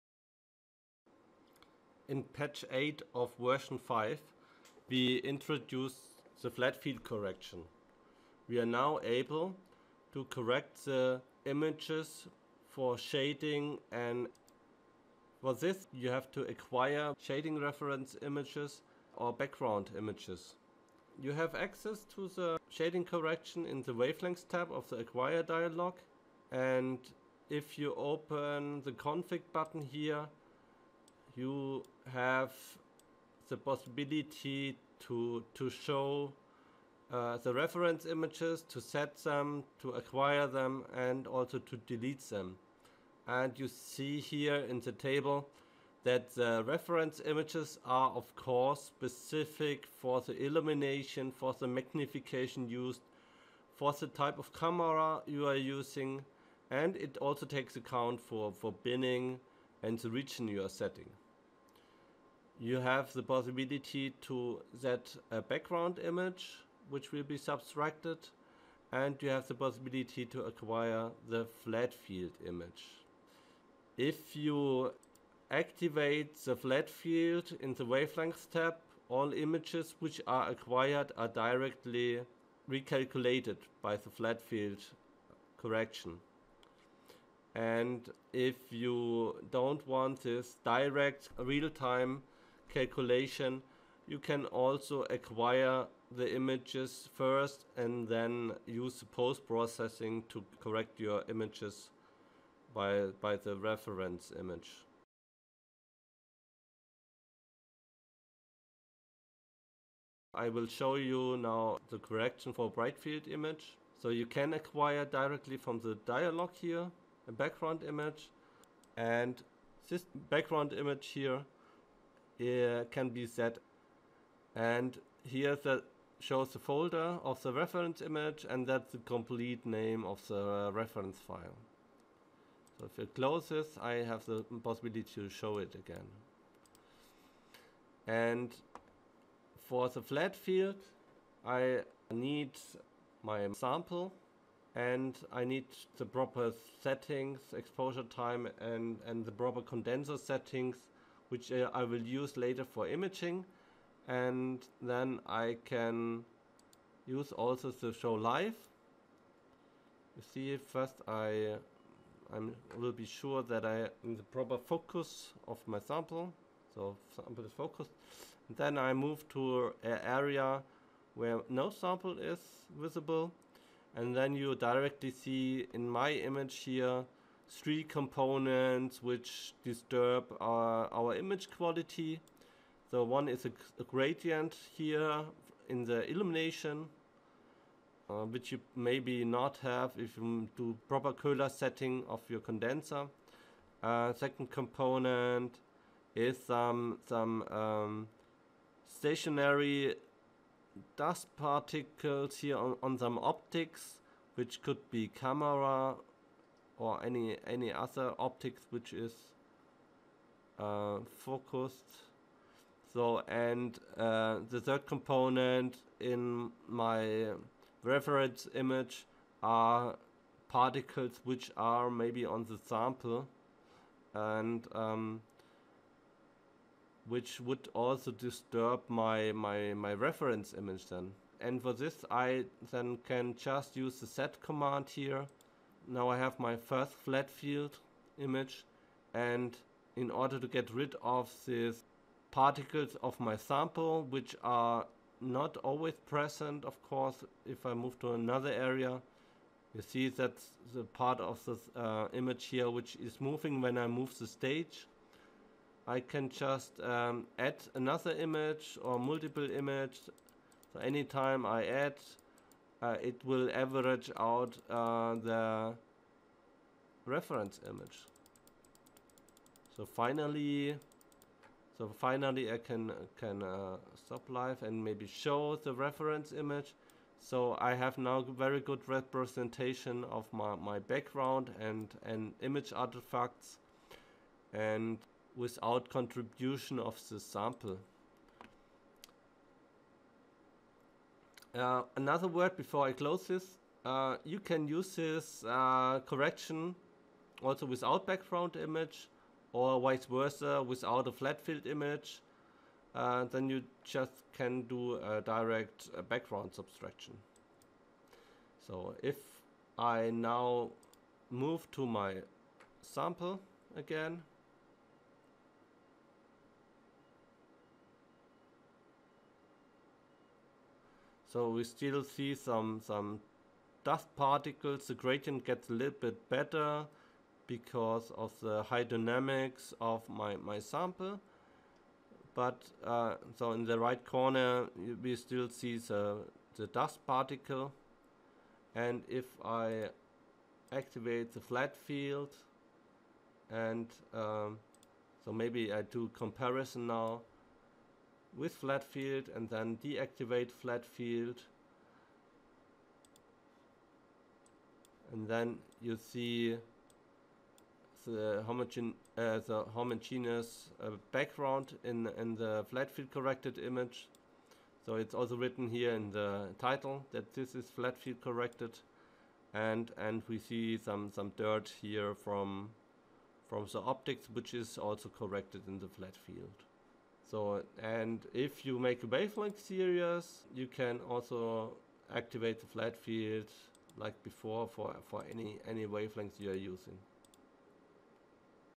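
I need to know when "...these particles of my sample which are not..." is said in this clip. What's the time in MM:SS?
04:01.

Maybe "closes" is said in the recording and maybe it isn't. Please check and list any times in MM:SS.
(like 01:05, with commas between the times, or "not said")
02:13, 04:52.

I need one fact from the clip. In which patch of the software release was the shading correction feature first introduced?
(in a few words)
Patch 8.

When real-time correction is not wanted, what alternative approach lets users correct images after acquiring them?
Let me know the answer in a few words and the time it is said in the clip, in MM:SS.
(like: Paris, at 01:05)
post-processing, at 01:39.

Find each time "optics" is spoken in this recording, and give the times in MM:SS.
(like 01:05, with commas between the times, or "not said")
03:23, 03:28, 06:13.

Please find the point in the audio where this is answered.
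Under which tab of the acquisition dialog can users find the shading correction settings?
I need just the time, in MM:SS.
00:23.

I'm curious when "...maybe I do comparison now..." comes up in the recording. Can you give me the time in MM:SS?
05:45.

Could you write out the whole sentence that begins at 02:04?
And here the, shows the folder of the reference image and that's the complete name of the reference file.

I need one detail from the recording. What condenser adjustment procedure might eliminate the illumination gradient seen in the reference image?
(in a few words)
Köhler setting.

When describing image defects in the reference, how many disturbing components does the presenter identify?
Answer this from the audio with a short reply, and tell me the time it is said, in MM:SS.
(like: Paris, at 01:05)
3, at 02:57.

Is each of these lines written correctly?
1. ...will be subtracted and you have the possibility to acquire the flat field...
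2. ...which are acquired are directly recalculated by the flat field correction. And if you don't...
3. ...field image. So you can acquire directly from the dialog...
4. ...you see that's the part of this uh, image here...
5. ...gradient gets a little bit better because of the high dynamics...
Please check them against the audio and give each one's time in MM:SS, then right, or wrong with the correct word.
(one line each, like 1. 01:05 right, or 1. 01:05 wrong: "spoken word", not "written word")
1. 01:07 right
2. 01:19 right
3. 01:52 right
4. 04:09 right
5. 05:24 right.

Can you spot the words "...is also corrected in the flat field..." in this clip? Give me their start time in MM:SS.
06:14.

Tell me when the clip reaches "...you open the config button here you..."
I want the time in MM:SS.
00:27.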